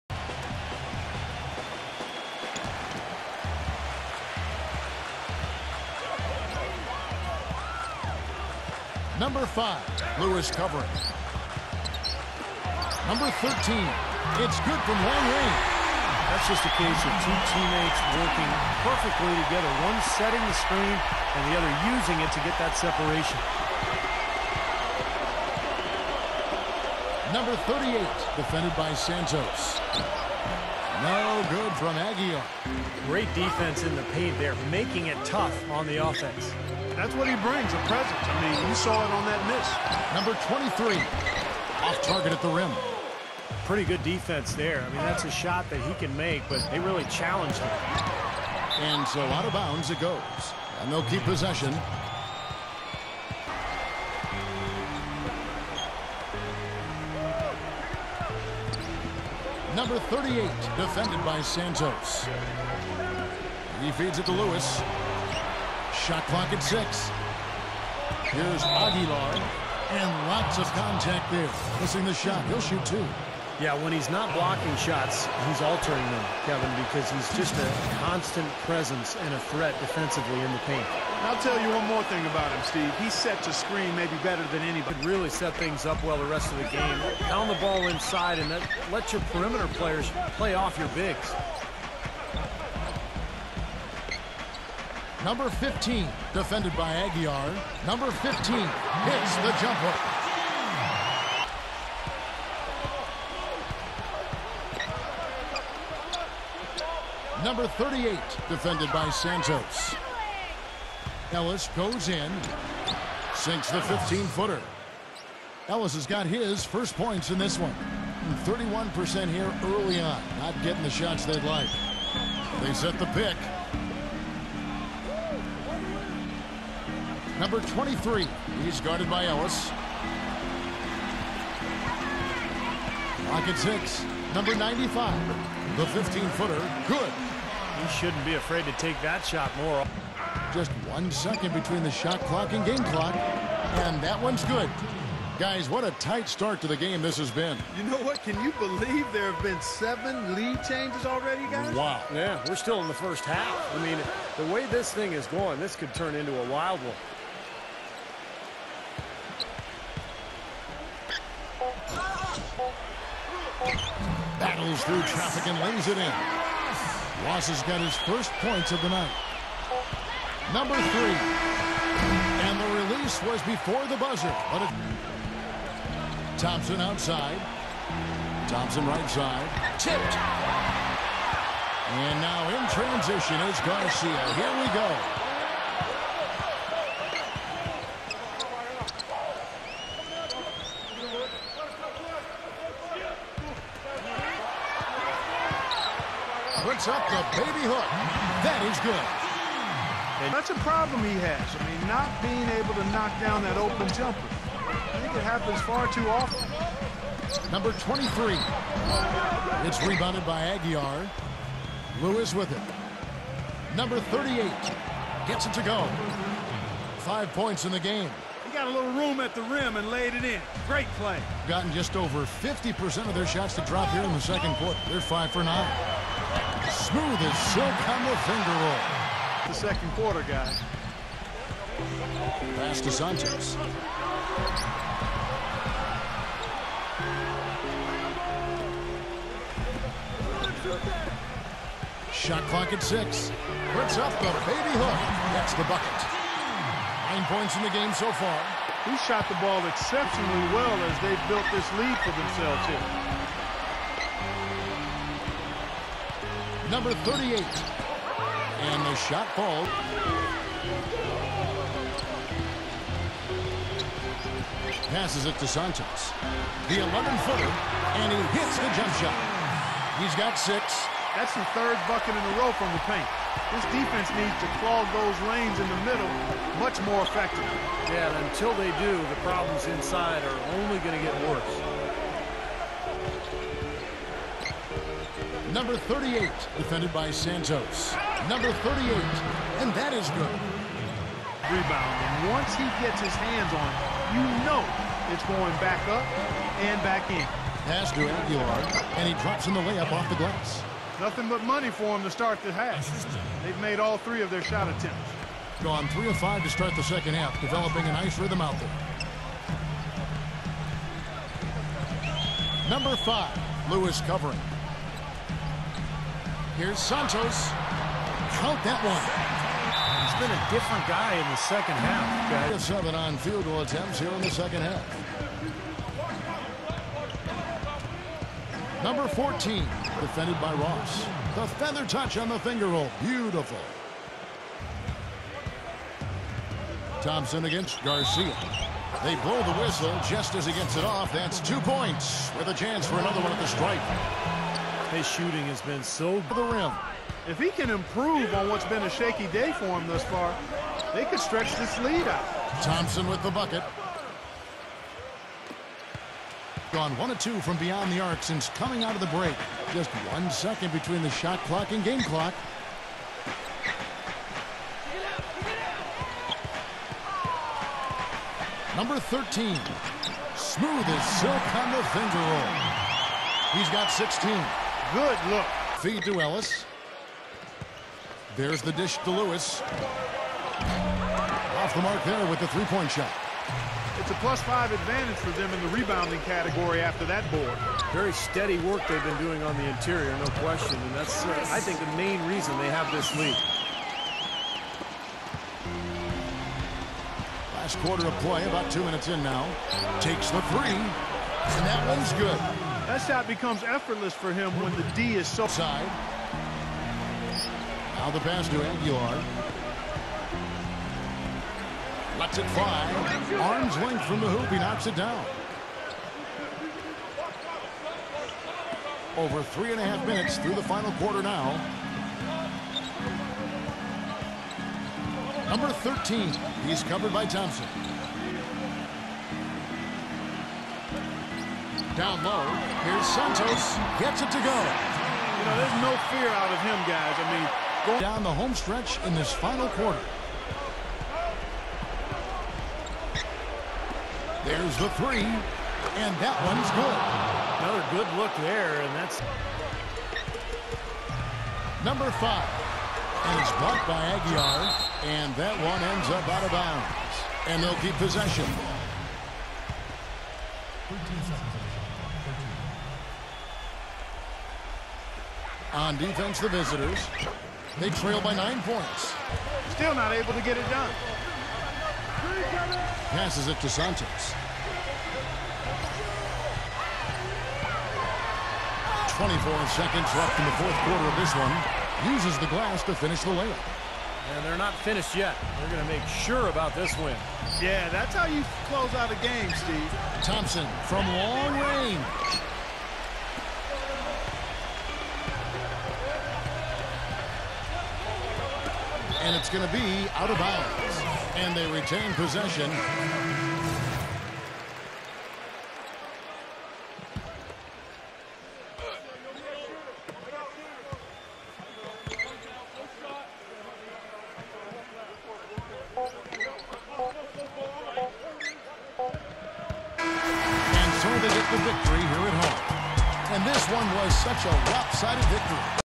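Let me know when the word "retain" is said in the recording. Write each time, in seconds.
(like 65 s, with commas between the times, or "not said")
501 s.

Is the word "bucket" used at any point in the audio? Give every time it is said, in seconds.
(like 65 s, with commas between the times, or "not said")
245 s, 271 s, 353 s.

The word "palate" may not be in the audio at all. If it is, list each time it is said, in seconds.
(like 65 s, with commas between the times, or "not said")
not said.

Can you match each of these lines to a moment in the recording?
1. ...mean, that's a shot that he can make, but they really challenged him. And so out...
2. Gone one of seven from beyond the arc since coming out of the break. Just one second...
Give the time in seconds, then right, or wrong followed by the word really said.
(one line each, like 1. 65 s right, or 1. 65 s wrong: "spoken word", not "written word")
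1. 44 s right
2. 356 s wrong: "two", not "seven".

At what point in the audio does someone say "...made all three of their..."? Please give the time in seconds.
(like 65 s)
303 s.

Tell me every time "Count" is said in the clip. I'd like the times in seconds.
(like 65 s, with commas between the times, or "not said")
318 s.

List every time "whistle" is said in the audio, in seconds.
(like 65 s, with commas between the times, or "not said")
339 s.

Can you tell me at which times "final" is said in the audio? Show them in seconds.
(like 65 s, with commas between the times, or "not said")
420 s, 439 s.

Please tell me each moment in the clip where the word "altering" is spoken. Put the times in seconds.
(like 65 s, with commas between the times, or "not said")
75 s.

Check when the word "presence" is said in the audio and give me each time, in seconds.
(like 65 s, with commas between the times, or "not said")
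37 s, 78 s.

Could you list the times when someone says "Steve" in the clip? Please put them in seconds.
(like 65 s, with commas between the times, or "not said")
82 s, 489 s.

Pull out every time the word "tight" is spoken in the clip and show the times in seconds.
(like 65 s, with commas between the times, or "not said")
145 s.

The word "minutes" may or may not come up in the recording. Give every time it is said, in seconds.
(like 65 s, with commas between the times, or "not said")
398 s, 420 s.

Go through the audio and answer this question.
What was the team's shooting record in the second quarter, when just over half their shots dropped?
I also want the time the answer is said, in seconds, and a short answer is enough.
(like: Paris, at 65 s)
5 for 9, at 224 s.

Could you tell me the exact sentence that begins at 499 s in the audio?
And it's going to be out of bounds.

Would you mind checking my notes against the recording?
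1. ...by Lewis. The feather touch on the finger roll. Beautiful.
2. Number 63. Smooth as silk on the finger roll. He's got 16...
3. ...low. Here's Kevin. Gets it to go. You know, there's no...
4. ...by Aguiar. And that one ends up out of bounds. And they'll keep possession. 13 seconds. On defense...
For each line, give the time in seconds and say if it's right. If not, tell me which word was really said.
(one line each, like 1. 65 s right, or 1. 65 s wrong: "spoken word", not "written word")
1. 330 s wrong: "Ross", not "Lewis"
2. 368 s wrong: "13", not "63"
3. 432 s wrong: "Santos", not "Kevin"
4. 453 s right.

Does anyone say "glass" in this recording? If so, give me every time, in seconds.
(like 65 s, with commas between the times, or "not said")
300 s, 482 s.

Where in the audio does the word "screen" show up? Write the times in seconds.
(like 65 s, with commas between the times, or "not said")
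20 s, 83 s.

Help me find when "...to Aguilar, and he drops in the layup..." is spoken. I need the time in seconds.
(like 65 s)
297 s.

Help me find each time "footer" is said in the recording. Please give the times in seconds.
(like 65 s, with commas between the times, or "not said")
113 s, 135 s, 266 s.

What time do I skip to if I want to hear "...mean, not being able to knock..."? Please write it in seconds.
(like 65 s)
201 s.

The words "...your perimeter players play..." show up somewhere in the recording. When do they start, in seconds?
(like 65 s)
89 s.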